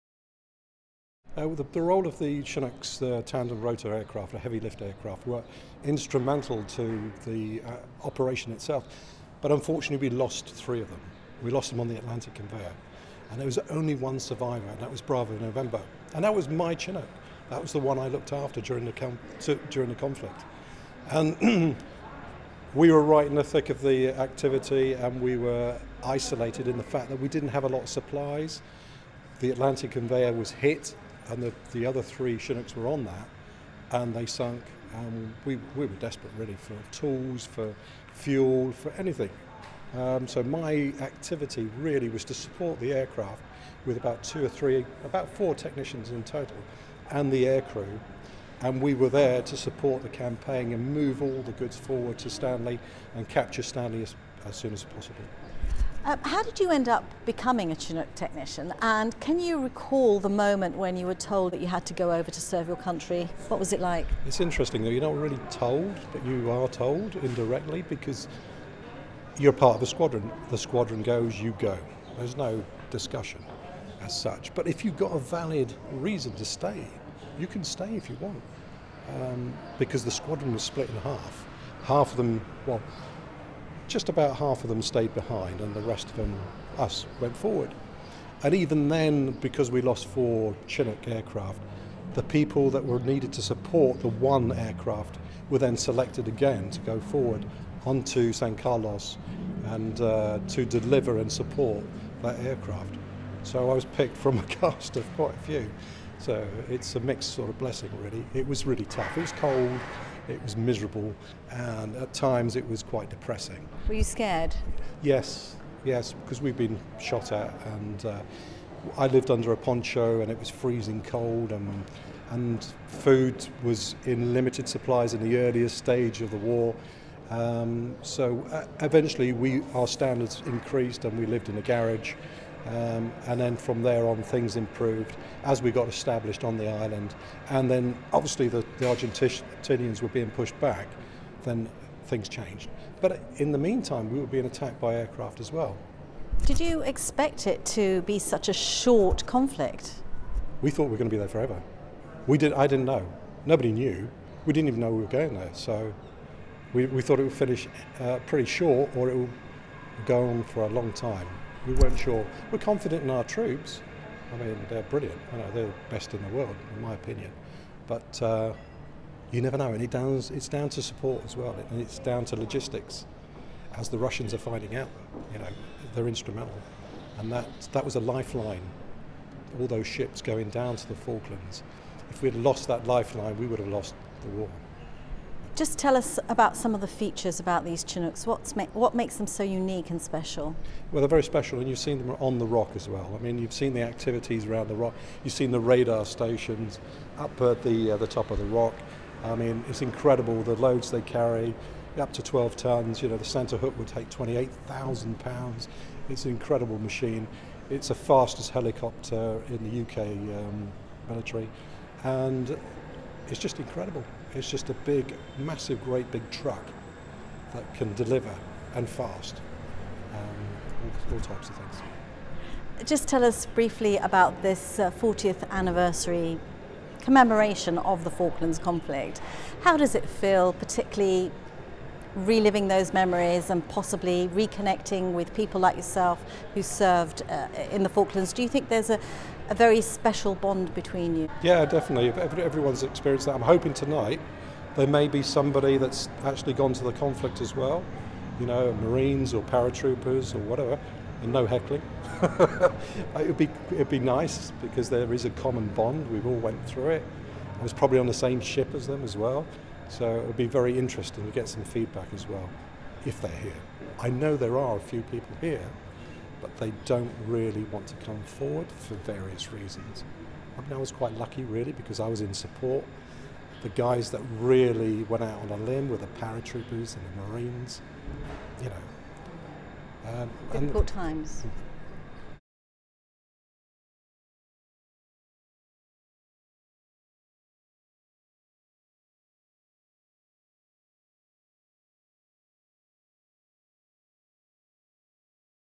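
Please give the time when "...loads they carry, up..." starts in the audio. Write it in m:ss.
3:20.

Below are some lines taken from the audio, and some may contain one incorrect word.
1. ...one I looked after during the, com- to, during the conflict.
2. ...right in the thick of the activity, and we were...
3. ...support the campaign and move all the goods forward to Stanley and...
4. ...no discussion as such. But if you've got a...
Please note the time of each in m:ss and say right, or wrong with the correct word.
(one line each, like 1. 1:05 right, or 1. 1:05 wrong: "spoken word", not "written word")
1. 0:17 right
2. 0:23 right
3. 0:49 right
4. 1:12 right.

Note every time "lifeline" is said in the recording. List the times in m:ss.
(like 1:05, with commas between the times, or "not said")
2:58, 3:02.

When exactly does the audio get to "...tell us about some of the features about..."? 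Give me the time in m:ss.
3:05.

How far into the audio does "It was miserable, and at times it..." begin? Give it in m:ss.
1:50.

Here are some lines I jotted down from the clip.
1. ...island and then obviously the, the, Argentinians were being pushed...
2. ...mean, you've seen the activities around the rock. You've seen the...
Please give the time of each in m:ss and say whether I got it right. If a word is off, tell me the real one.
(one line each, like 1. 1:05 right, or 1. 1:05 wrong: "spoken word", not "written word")
1. 2:16 right
2. 3:13 right.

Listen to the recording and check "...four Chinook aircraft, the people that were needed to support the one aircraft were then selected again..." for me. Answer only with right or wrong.
right.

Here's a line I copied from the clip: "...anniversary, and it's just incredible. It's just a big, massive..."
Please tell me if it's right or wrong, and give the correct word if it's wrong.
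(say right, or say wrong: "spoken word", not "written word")
wrong: "military", not "anniversary".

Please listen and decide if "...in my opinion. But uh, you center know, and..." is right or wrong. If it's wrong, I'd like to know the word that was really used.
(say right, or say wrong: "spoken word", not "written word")
wrong: "never", not "center".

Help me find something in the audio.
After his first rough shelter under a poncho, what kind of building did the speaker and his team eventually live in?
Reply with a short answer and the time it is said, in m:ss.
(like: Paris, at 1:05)
A garage, at 2:11.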